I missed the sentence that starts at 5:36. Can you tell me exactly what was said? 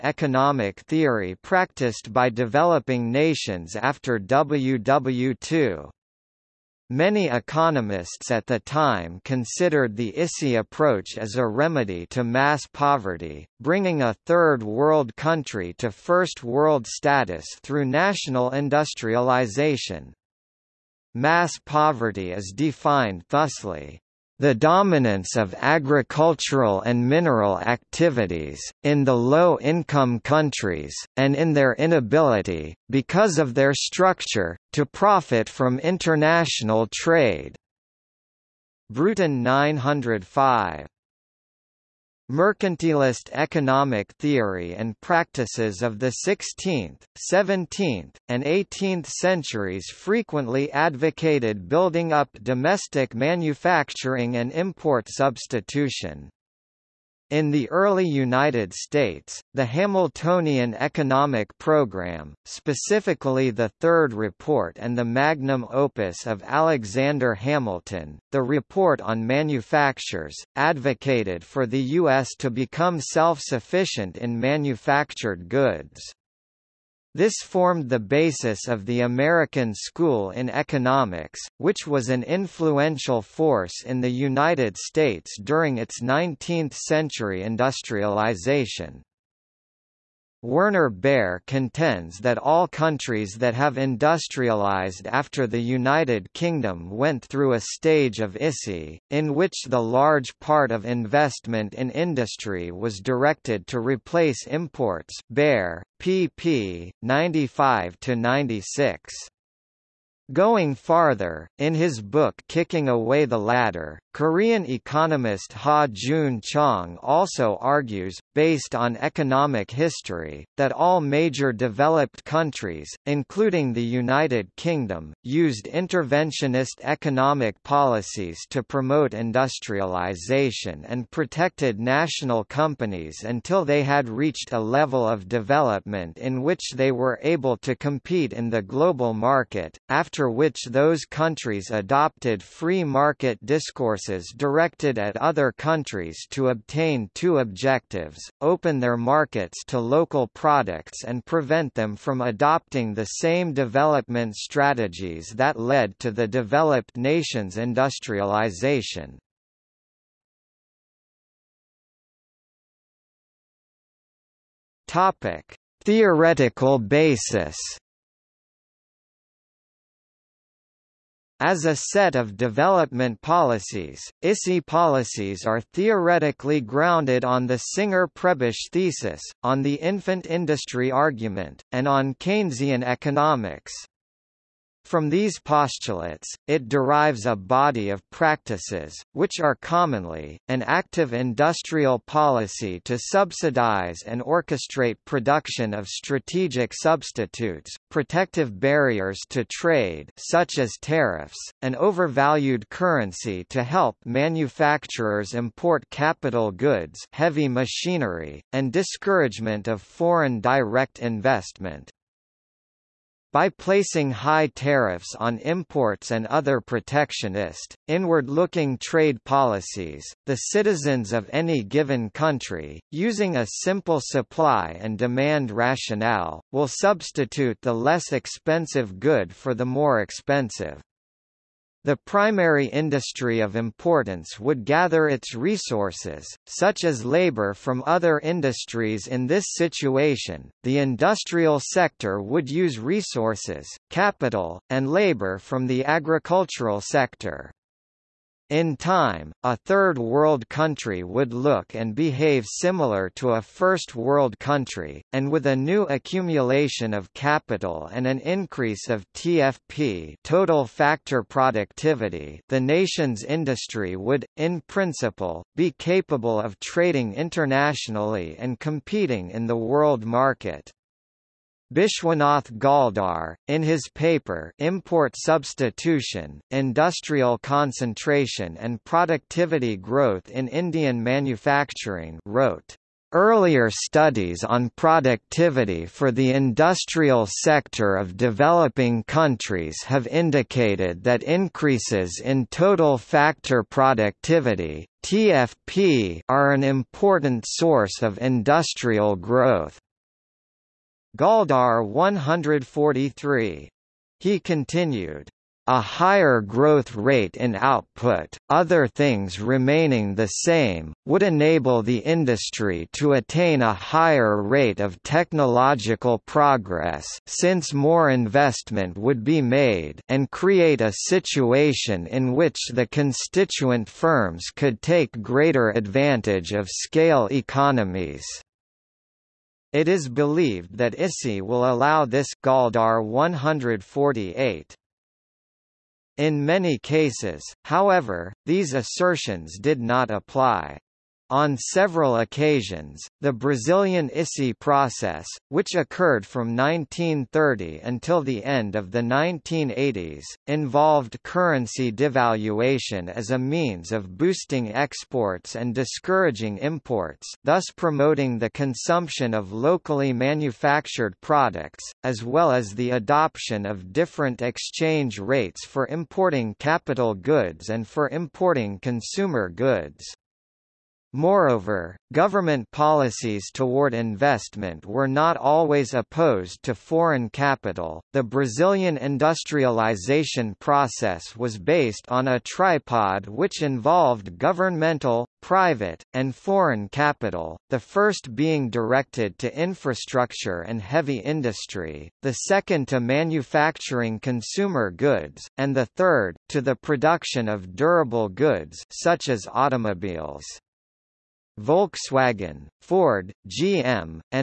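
In many cases, however, these assertions did not apply.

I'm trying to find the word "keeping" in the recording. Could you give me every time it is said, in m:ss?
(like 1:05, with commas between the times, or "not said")
not said.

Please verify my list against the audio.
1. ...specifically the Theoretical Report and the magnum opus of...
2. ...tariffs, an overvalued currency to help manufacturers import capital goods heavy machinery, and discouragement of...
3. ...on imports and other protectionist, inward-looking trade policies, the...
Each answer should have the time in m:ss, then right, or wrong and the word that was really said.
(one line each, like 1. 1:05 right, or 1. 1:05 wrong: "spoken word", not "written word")
1. 1:02 wrong: "Third", not "Theoretical"
2. 3:20 right
3. 3:35 right.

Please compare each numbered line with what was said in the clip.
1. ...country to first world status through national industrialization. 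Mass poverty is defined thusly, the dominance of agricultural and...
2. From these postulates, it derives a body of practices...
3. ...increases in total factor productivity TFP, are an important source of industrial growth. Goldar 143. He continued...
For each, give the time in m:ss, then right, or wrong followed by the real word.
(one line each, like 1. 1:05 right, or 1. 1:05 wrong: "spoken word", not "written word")
1. 0:15 right
2. 3:04 right
3. 4:51 right.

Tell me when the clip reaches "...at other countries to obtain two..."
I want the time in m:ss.
2:24.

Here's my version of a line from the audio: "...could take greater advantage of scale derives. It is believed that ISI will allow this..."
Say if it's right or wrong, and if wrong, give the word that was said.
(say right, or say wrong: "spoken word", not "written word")
wrong: "economies", not "derives".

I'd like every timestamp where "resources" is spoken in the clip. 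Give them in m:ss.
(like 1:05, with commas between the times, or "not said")
3:55, 4:02.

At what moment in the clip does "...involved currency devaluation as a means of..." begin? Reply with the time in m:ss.
5:50.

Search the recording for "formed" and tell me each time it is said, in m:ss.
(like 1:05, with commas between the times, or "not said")
1:17.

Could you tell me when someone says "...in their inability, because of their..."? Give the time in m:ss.
0:31.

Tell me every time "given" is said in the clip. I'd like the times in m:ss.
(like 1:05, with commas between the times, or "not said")
3:41.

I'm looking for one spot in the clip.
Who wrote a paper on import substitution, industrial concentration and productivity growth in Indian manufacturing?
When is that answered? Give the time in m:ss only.
4:31.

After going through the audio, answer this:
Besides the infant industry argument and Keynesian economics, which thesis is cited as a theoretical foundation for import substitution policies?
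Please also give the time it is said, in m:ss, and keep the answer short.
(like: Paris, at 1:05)
Singer-Prebisch thesis, at 2:57.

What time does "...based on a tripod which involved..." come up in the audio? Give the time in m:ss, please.
6:21.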